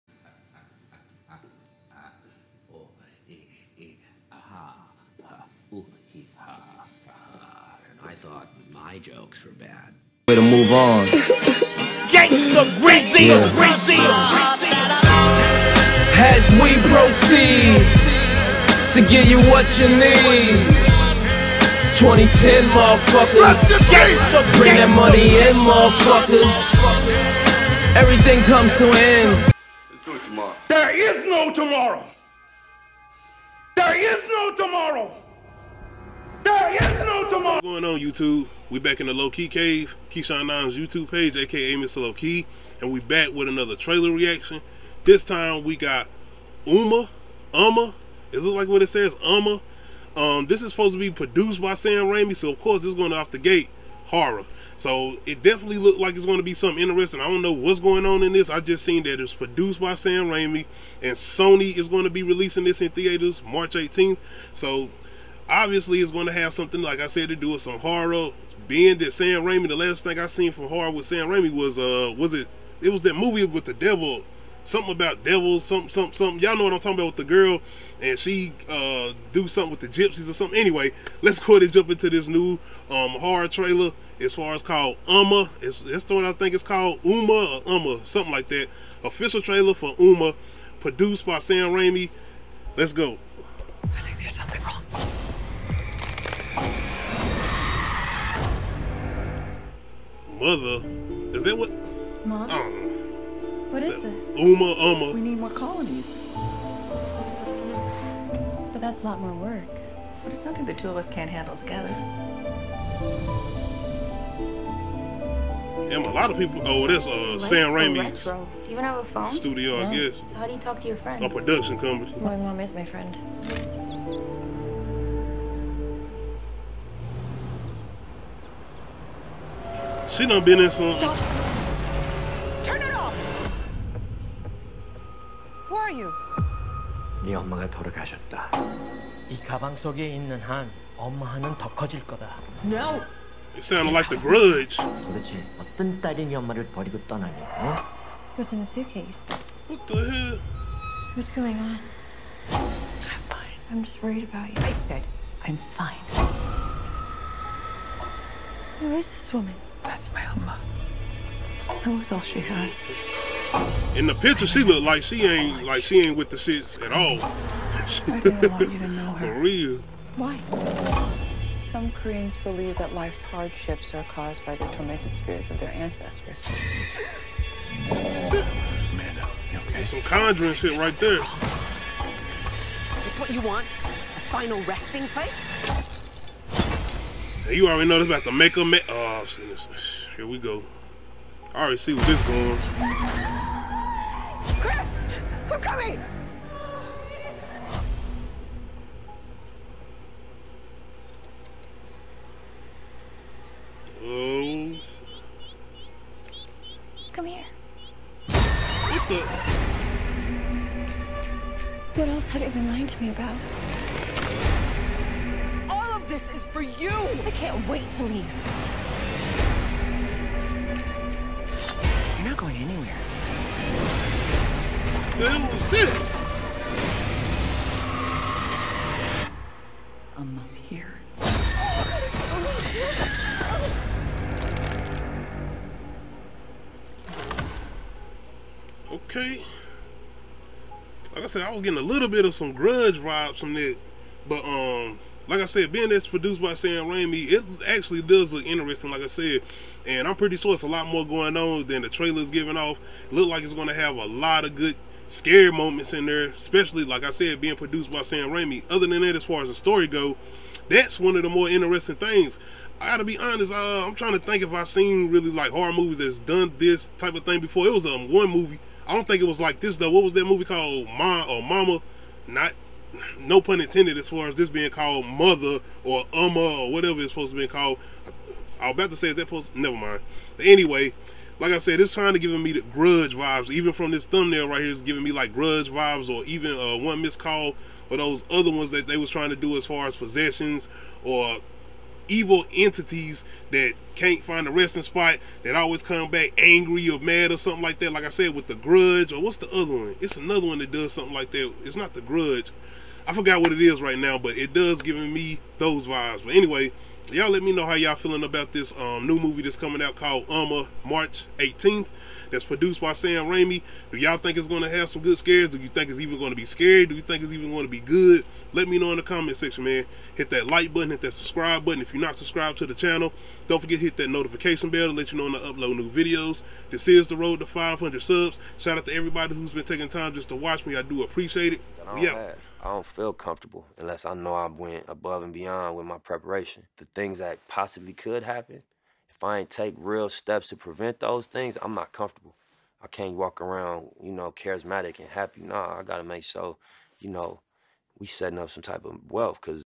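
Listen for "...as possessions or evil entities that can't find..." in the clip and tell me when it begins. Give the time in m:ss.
4:49.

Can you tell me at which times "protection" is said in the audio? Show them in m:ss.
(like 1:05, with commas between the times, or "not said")
not said.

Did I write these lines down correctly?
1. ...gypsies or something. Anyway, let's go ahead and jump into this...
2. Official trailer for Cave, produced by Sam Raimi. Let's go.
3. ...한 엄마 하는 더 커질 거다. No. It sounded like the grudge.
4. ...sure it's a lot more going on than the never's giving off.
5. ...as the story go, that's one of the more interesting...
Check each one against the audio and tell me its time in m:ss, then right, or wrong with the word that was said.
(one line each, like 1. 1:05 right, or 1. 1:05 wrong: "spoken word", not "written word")
1. 1:19 right
2. 1:29 wrong: "Umma", not "Cave"
3. 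2:20 right
4. 4:10 wrong: "trailer", not "never"
5. 4:19 right.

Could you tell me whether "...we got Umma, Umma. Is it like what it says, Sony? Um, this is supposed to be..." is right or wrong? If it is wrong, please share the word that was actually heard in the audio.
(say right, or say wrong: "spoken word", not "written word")
wrong: "Umma", not "Sony".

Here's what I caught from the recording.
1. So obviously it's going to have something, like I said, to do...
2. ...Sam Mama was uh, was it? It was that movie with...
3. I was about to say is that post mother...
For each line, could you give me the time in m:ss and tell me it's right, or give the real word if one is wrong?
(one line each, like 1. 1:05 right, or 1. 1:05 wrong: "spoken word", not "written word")
1. 1:04 right
2. 1:11 wrong: "Raimi", not "Mama"
3. 4:38 wrong: "never", not "mother".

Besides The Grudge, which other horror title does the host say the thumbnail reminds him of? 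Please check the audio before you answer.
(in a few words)
One Missed Call.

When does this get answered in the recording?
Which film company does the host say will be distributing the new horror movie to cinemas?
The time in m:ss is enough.
1:01.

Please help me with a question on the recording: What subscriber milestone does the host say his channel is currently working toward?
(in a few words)
500 subs.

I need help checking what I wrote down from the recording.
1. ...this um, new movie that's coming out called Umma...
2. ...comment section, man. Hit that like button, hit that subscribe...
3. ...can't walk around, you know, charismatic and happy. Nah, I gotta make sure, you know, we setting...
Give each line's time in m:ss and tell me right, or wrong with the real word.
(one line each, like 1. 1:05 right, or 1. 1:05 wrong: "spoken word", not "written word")
1. 5:08 right
2. 5:19 right
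3. 5:42 right.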